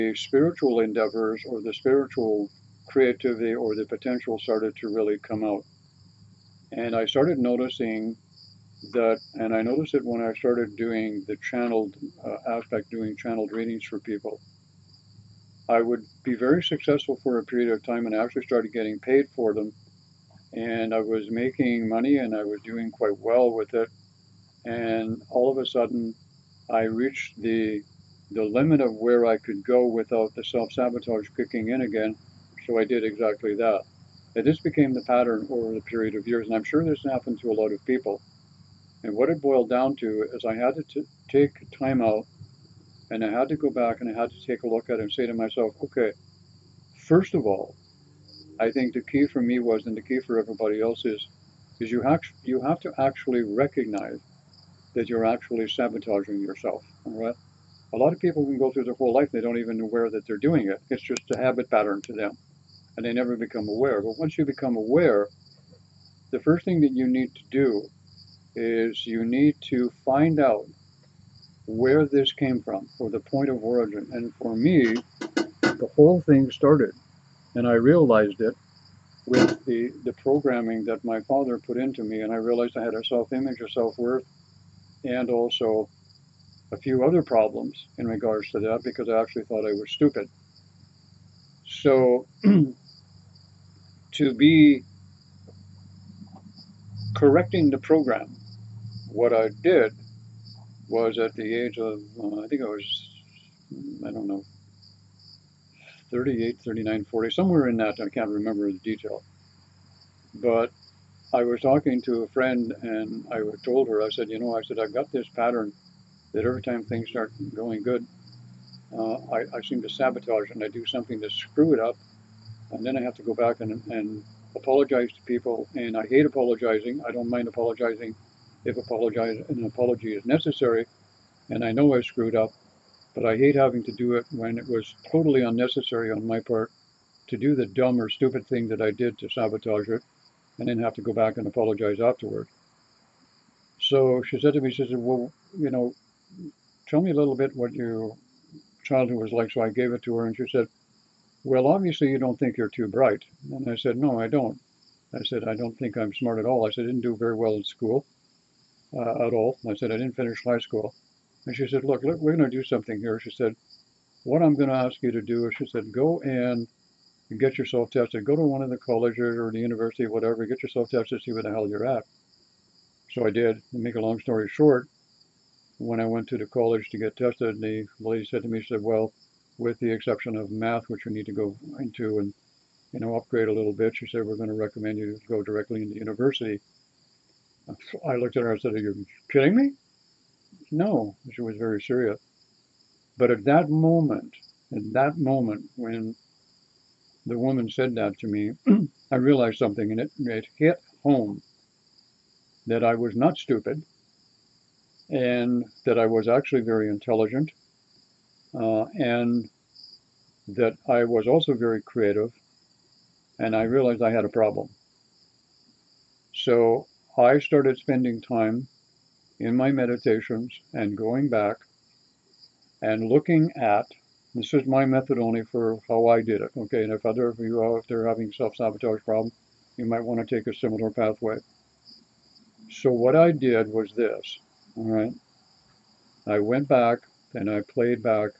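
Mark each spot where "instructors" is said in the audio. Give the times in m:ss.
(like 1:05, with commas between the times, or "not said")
not said.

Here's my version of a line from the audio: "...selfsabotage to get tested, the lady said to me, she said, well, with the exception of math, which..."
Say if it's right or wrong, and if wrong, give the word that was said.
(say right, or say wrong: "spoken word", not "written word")
wrong: "college", not "selfsabotage".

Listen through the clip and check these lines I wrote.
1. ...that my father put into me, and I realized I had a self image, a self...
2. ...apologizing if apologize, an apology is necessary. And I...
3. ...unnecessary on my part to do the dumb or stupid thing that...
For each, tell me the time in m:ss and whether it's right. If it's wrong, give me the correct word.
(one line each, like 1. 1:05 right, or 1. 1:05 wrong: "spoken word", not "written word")
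1. 1:20 right
2. 2:07 right
3. 2:15 right.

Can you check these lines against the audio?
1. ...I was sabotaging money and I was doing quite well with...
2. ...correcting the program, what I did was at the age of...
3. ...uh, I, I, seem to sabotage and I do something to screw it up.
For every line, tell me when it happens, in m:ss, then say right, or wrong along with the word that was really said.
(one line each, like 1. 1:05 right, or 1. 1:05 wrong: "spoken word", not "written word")
1. 0:20 wrong: "making", not "sabotaging"
2. 1:37 right
3. 1:58 right.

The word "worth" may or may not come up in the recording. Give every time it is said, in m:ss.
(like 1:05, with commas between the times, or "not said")
1:23.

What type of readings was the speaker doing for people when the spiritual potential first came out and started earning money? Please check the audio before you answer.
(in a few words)
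channeled readings.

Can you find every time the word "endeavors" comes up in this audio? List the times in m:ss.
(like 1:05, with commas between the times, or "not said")
0:00.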